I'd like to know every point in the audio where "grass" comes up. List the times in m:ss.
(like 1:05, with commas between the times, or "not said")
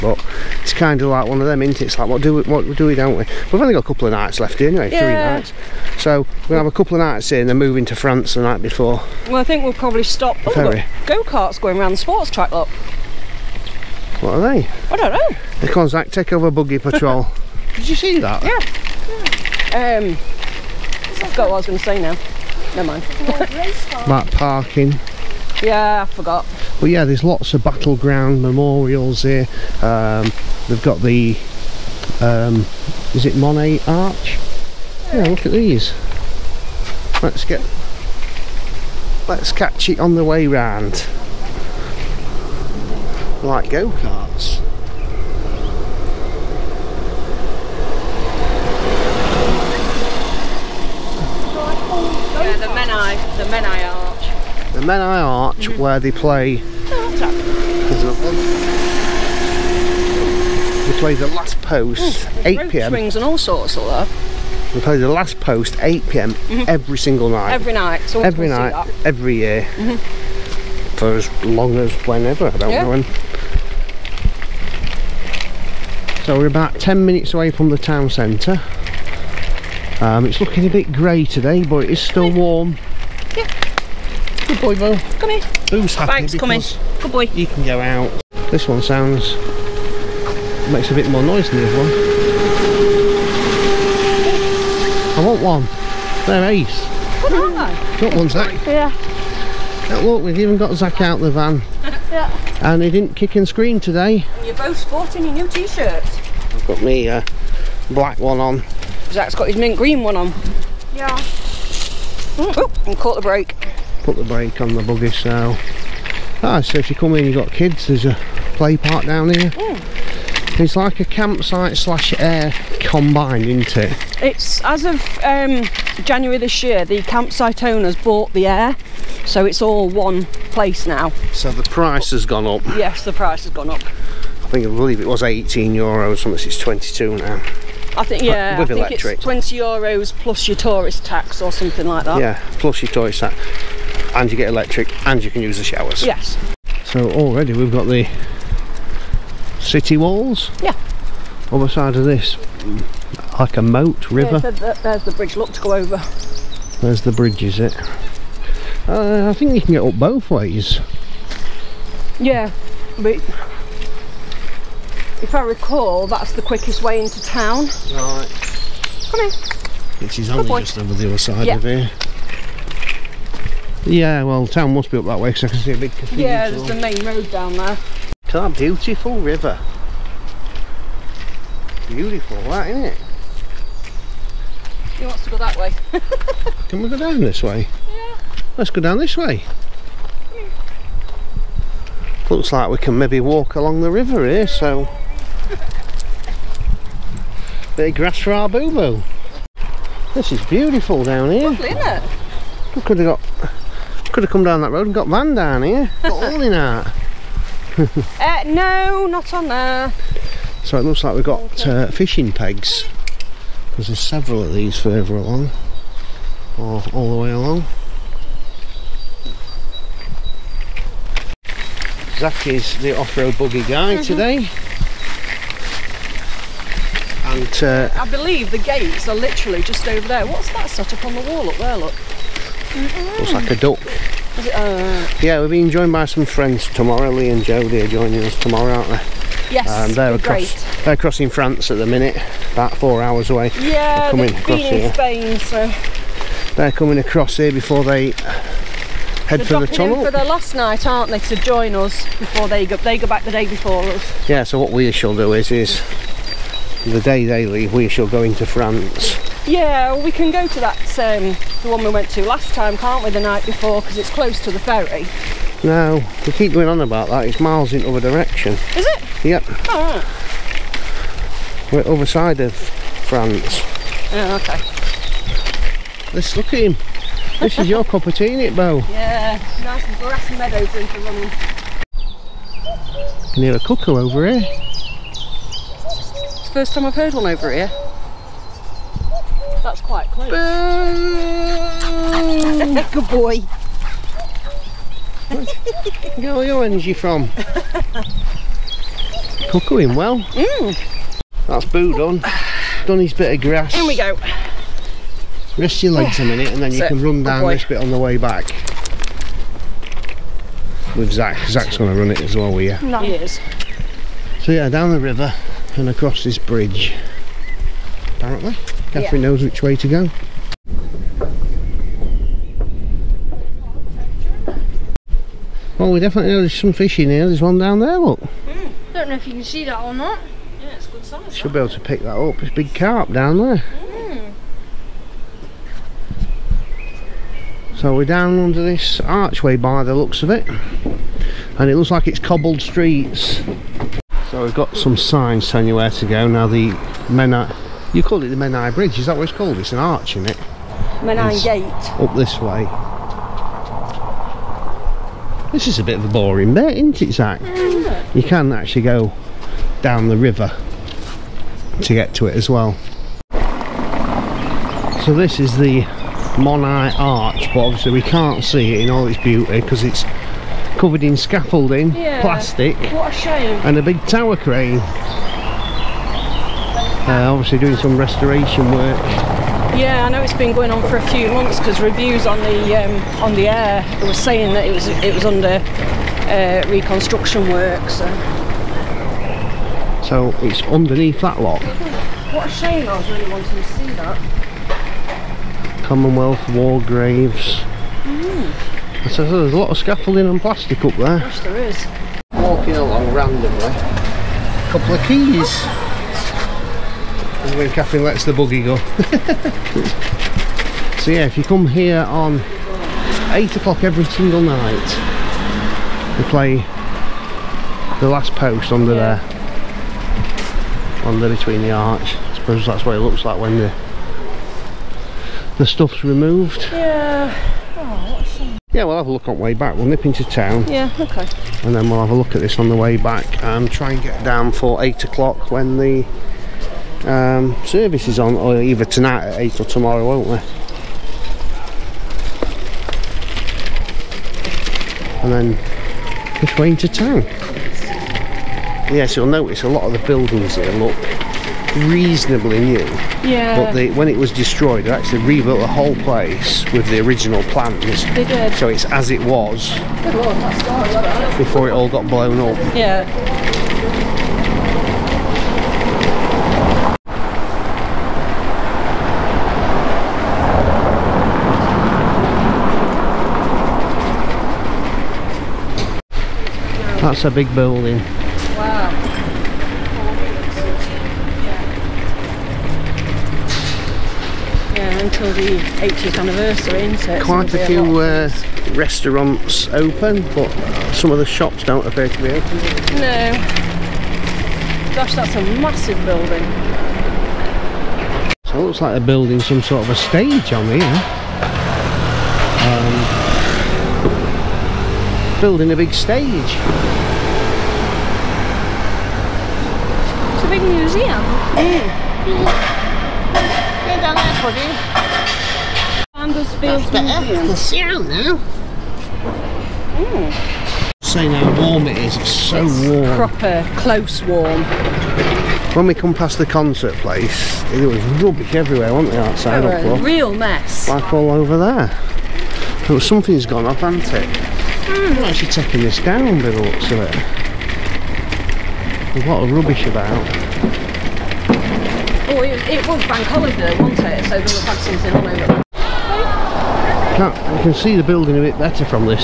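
3:17, 5:03.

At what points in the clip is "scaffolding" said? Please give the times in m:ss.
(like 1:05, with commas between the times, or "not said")
6:11, 6:39.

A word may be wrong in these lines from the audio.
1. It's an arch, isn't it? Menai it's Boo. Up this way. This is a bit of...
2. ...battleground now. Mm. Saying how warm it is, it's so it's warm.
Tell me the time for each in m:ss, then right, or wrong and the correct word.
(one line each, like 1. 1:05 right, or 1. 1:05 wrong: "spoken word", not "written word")
1. 5:49 wrong: "Gate", not "Boo"
2. 8:37 wrong: "sound", not "battleground".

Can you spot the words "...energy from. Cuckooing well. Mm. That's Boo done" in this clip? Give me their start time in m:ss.
4:56.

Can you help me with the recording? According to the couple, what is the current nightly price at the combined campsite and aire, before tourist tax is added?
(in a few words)
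20 euros.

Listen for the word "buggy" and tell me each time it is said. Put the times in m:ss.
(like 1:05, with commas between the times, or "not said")
0:16, 1:54, 3:43, 6:48.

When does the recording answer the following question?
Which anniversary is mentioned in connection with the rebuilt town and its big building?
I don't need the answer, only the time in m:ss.
8:05.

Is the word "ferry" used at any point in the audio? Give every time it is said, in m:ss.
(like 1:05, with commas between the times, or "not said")
0:10, 4:24.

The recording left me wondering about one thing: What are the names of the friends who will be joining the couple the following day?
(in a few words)
Lee and Jodie.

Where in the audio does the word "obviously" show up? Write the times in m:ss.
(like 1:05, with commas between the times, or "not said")
6:07, 6:17.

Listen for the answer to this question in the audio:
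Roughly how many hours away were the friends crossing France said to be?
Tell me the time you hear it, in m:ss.
4:02.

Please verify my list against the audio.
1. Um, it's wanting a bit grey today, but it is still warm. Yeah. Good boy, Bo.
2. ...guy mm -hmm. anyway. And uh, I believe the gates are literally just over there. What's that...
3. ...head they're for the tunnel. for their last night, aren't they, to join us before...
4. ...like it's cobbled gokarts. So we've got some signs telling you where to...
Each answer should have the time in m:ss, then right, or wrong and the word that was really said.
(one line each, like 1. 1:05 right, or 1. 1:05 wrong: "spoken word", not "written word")
1. 1:20 wrong: "looking", not "wanting"
2. 3:43 wrong: "today", not "anyway"
3. 4:09 right
4. 5:41 wrong: "streets", not "gokarts".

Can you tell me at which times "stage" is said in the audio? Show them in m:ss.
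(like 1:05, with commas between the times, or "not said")
8:19, 8:25.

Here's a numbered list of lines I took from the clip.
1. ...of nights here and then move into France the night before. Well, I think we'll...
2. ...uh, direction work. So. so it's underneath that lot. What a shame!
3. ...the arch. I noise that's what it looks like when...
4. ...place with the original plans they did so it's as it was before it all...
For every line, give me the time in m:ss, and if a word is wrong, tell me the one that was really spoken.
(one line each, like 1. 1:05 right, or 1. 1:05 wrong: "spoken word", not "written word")
1. 0:06 right
2. 6:26 wrong: "reconstruction", not "direction"
3. 7:01 wrong: "suppose", not "noise"
4. 7:35 right.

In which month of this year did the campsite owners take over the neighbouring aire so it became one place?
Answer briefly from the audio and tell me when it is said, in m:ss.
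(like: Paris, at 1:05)
January, at 2:06.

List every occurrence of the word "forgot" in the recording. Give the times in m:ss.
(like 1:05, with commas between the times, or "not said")
0:21, 0:26.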